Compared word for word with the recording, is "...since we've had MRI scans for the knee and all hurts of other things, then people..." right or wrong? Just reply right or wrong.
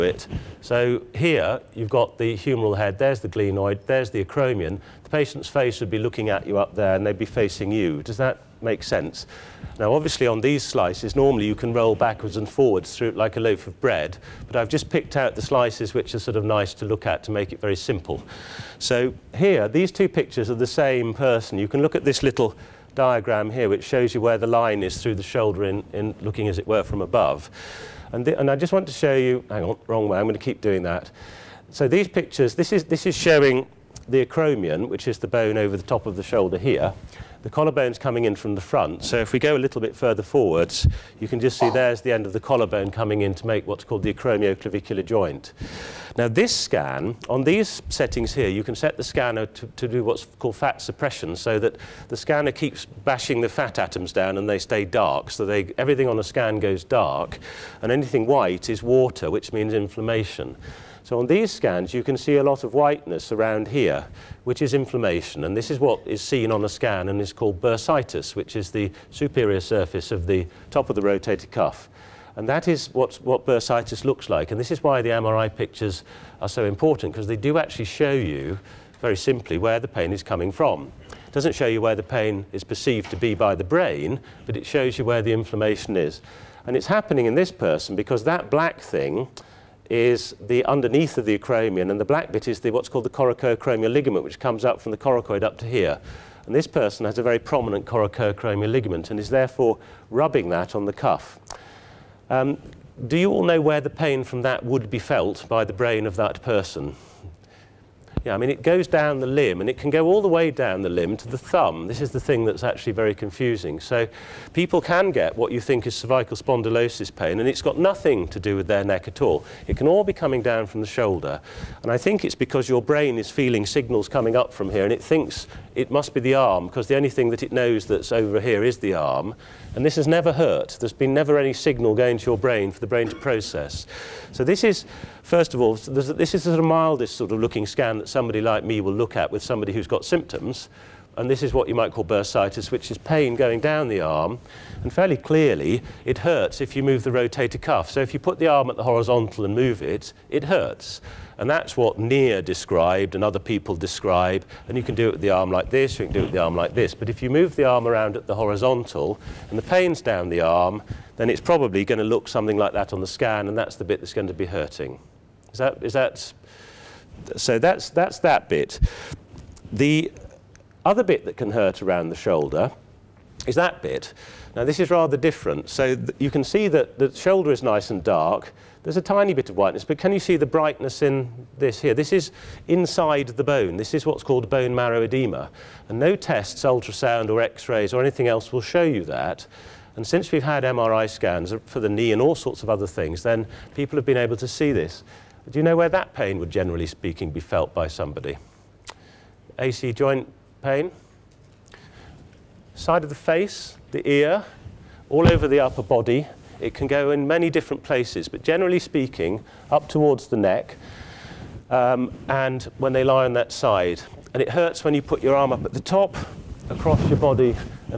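wrong.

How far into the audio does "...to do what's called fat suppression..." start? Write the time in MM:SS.
00:49.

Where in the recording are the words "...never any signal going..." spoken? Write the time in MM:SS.
02:11.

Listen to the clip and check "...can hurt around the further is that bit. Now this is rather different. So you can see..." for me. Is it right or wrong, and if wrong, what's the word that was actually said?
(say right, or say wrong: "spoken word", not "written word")
wrong: "shoulder", not "further".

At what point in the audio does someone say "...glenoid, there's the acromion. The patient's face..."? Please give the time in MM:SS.
00:03.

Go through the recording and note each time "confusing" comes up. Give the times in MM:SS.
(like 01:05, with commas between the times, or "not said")
01:53.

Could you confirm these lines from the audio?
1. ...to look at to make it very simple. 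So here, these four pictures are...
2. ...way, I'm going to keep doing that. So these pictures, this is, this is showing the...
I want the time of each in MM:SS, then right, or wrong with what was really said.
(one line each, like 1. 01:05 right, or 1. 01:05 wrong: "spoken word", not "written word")
1. 00:16 wrong: "two", not "four"
2. 00:30 right.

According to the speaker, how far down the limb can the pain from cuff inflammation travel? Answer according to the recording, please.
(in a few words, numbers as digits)
to the thumb.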